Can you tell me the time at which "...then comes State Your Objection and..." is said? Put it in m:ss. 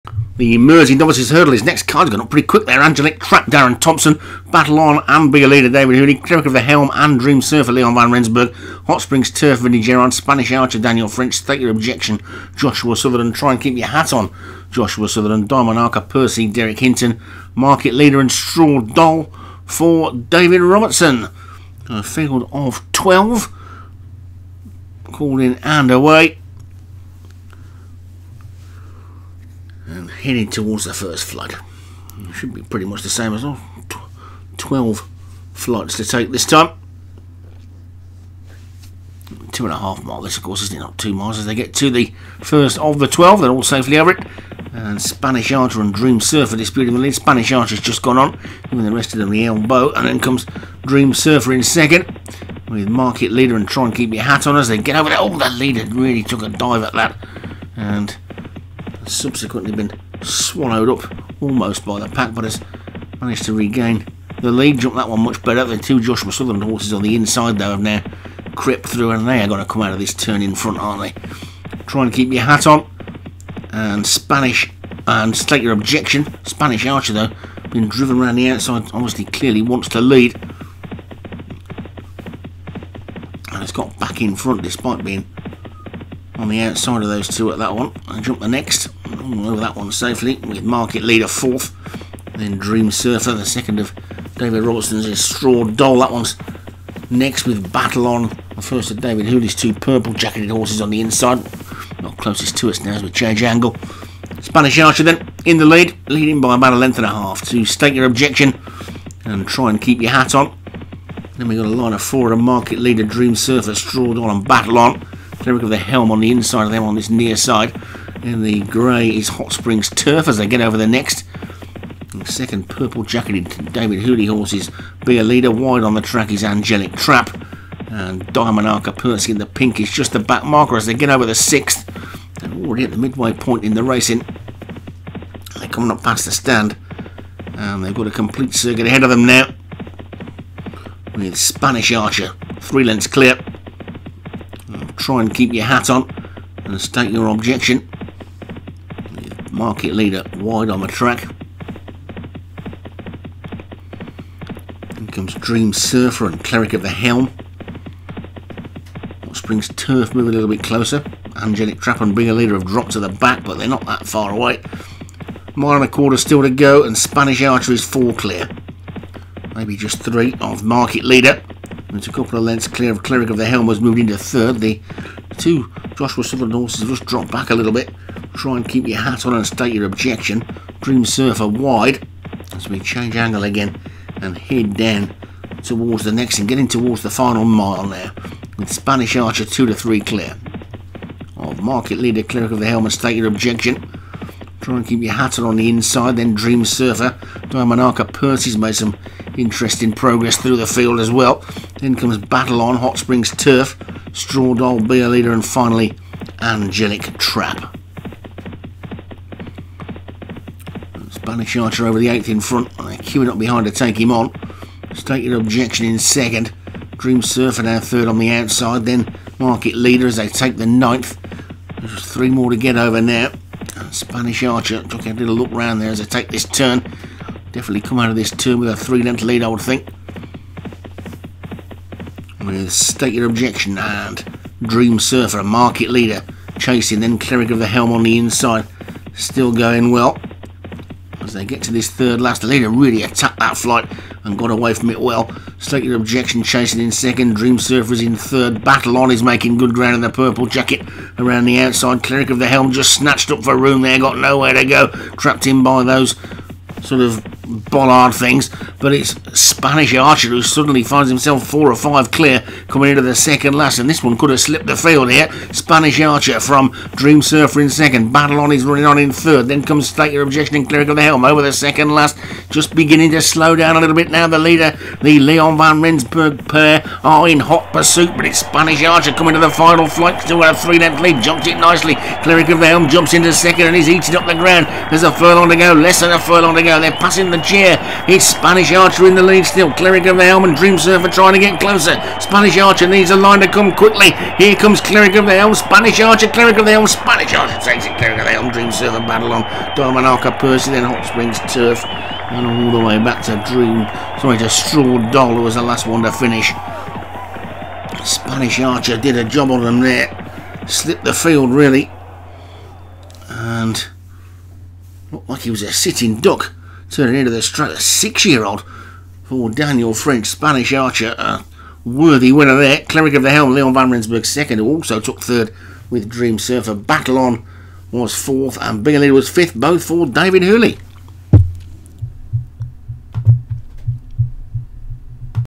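4:29.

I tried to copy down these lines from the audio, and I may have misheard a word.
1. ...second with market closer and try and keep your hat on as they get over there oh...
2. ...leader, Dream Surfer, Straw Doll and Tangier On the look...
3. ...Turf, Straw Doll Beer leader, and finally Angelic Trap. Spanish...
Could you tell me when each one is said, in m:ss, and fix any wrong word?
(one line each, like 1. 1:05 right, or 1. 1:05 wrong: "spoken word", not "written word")
1. 0:51 wrong: "leader", not "closer"
2. 1:52 wrong: "Battle", not "Tangier"
3. 3:23 right.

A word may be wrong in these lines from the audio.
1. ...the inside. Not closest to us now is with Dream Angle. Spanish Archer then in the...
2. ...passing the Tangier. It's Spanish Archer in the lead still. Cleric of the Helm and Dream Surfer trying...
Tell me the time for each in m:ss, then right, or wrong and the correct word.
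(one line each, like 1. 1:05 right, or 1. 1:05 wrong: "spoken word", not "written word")
1. 1:40 wrong: "Change", not "Dream"
2. 4:46 right.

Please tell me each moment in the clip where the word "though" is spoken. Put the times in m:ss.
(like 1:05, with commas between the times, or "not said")
1:07, 1:17.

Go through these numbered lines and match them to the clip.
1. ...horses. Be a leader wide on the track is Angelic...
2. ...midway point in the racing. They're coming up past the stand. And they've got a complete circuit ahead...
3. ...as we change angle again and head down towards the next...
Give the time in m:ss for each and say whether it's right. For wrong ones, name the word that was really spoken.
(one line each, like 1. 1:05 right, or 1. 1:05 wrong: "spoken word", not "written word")
1. 2:04 right
2. 2:12 right
3. 3:02 right.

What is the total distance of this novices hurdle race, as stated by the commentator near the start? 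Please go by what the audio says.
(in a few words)
Two and a half miles.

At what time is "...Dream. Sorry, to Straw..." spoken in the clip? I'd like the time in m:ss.
5:03.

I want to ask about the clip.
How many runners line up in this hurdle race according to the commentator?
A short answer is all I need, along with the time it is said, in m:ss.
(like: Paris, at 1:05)
12, at 0:21.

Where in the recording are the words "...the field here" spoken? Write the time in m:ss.
4:24.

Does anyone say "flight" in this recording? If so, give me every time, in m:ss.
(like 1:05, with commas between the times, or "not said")
0:35, 4:03, 4:39.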